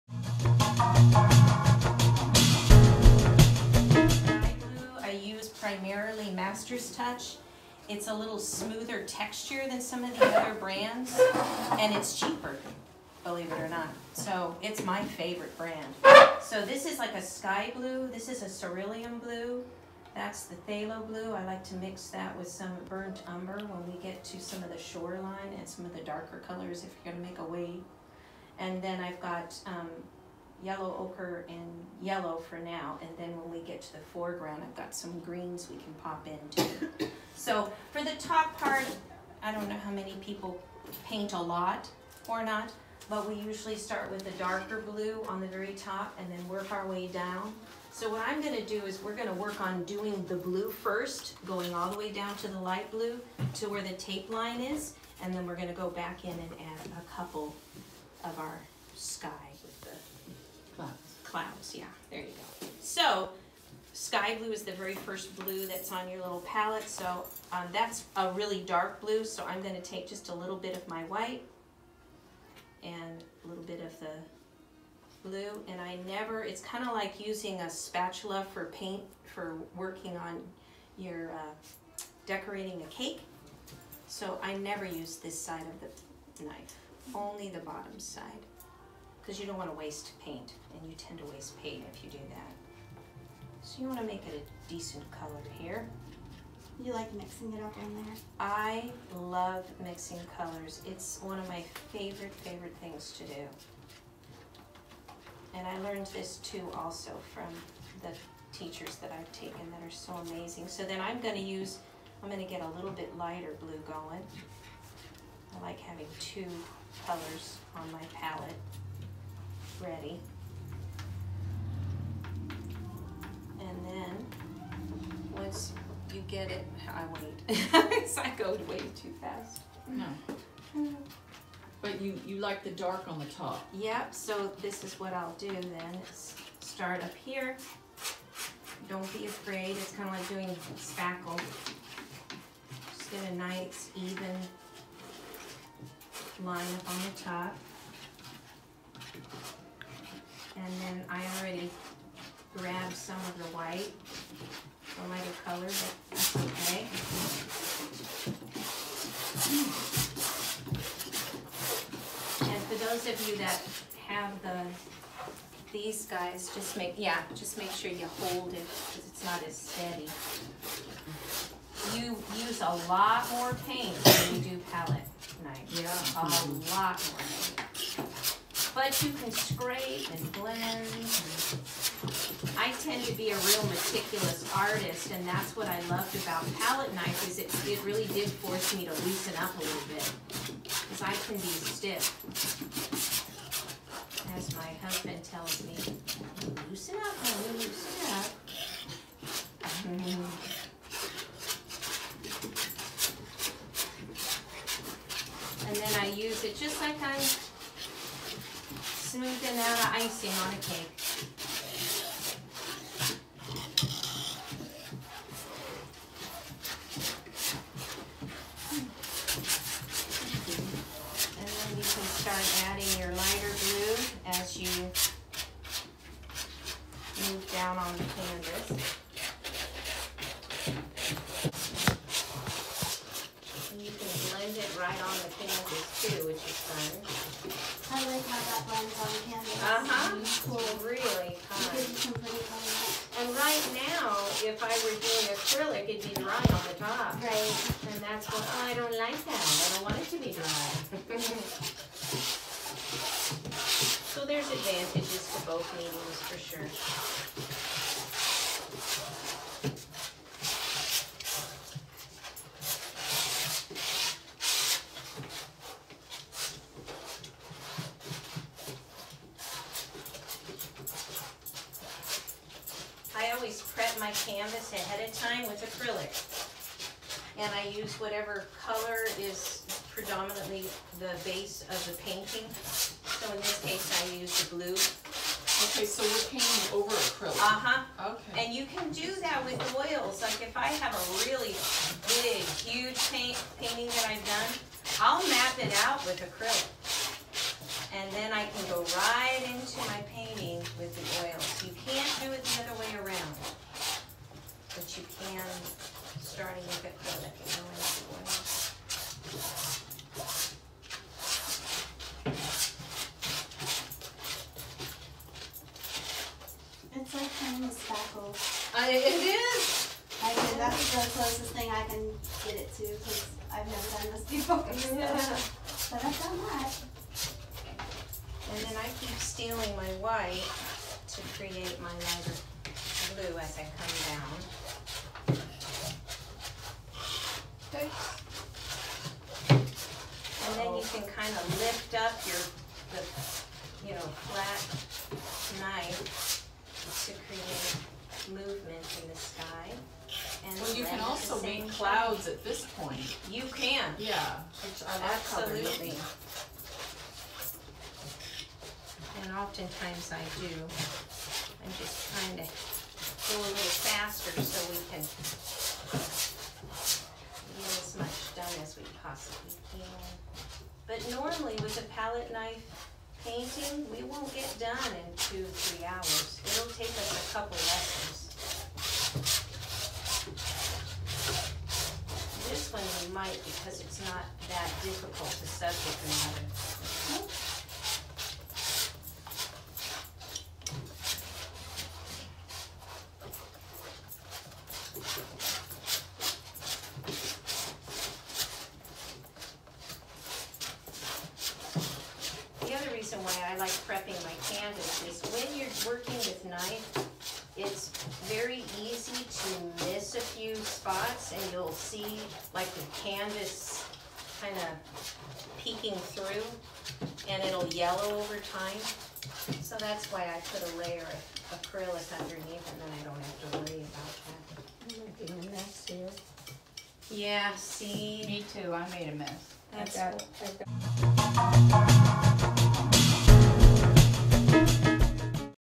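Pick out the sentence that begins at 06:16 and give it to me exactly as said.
It'll take us a couple lessons.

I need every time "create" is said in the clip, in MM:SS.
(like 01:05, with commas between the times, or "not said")
05:31, 05:47.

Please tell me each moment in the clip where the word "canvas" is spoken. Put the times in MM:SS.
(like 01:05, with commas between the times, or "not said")
03:48, 04:34, 06:53.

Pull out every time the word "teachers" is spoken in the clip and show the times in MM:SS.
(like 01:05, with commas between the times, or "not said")
01:48.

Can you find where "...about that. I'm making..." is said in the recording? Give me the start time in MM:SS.
07:03.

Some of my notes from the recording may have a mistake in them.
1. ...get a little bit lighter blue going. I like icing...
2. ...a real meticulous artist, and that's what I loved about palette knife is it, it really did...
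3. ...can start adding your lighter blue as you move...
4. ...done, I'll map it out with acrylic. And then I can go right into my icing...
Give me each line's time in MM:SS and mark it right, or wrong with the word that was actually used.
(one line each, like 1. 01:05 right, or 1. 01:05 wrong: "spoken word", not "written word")
1. 01:52 wrong: "having", not "icing"
2. 03:03 right
3. 03:41 right
4. 04:54 wrong: "painting", not "icing".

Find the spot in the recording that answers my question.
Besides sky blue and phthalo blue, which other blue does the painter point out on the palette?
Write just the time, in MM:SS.
00:18.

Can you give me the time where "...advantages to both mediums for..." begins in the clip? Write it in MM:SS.
04:14.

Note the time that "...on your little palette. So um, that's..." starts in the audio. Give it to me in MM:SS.
01:05.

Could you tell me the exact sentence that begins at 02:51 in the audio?
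You use a lot more paint when you do palette knife.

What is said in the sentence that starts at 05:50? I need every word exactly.
And well, you can also make clouds at this point.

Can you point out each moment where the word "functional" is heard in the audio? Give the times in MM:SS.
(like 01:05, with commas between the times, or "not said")
not said.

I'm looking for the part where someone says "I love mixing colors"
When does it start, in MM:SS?
01:38.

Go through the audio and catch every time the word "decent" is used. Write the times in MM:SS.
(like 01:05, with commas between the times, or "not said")
01:34.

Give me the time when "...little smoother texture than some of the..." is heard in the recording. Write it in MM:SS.
00:08.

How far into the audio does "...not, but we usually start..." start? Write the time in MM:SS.
00:42.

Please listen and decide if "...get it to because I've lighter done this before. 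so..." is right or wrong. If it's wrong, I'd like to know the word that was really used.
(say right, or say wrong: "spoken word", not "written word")
wrong: "never", not "lighter".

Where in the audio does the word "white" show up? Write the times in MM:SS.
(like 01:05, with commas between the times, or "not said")
01:11, 02:33, 05:30.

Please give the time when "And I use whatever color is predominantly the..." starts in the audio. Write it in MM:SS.
04:37.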